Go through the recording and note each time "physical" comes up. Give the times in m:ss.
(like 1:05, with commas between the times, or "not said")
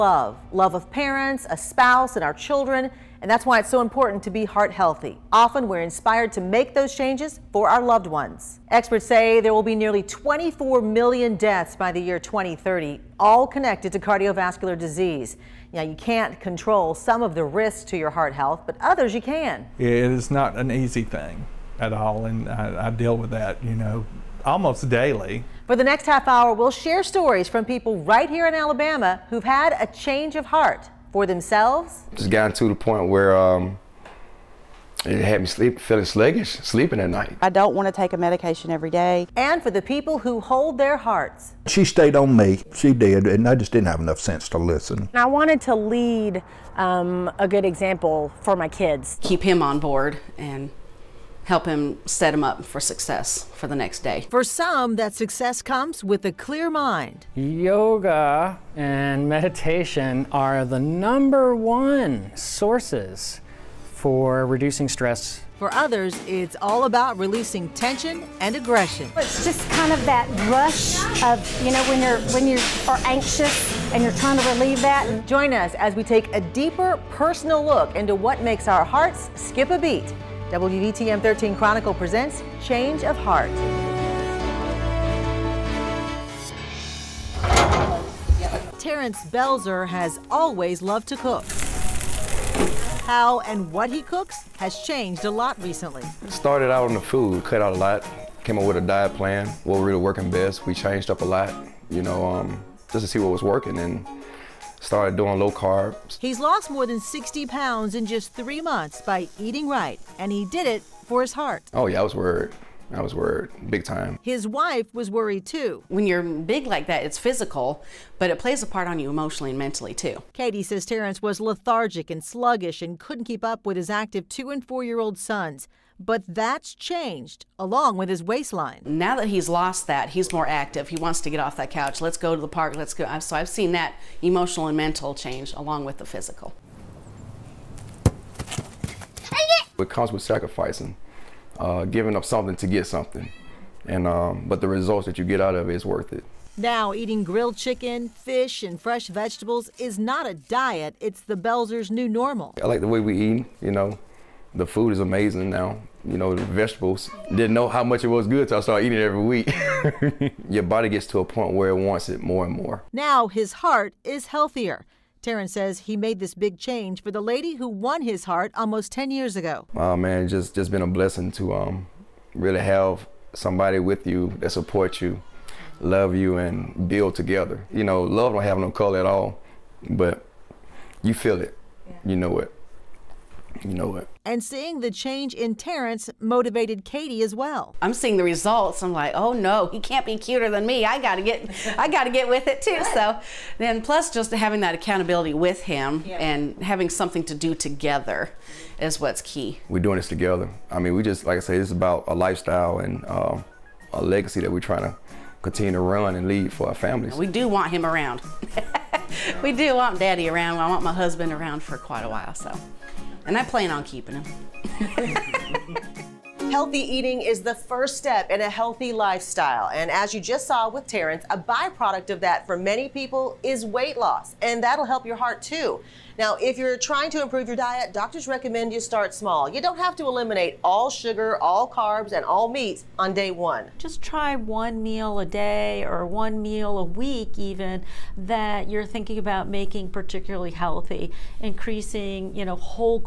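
1:57, 2:16.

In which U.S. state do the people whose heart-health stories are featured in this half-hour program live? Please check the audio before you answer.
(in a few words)
Alabama.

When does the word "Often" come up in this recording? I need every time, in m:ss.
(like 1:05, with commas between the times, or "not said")
0:05.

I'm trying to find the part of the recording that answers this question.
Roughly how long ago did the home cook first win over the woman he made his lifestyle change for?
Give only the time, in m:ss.
2:48.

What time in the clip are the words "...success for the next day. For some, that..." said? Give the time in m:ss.
0:52.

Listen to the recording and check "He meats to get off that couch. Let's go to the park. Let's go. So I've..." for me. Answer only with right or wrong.
wrong.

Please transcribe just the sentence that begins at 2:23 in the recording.
And um, but the results that you get out of it is worth it.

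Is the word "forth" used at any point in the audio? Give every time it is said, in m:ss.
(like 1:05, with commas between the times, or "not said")
not said.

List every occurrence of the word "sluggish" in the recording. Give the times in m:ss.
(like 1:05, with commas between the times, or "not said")
0:36, 2:02.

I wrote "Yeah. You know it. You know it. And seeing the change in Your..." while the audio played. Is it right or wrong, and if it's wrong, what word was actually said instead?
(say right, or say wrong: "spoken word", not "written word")
wrong: "Terrence", not "Your".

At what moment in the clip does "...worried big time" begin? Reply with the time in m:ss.
1:53.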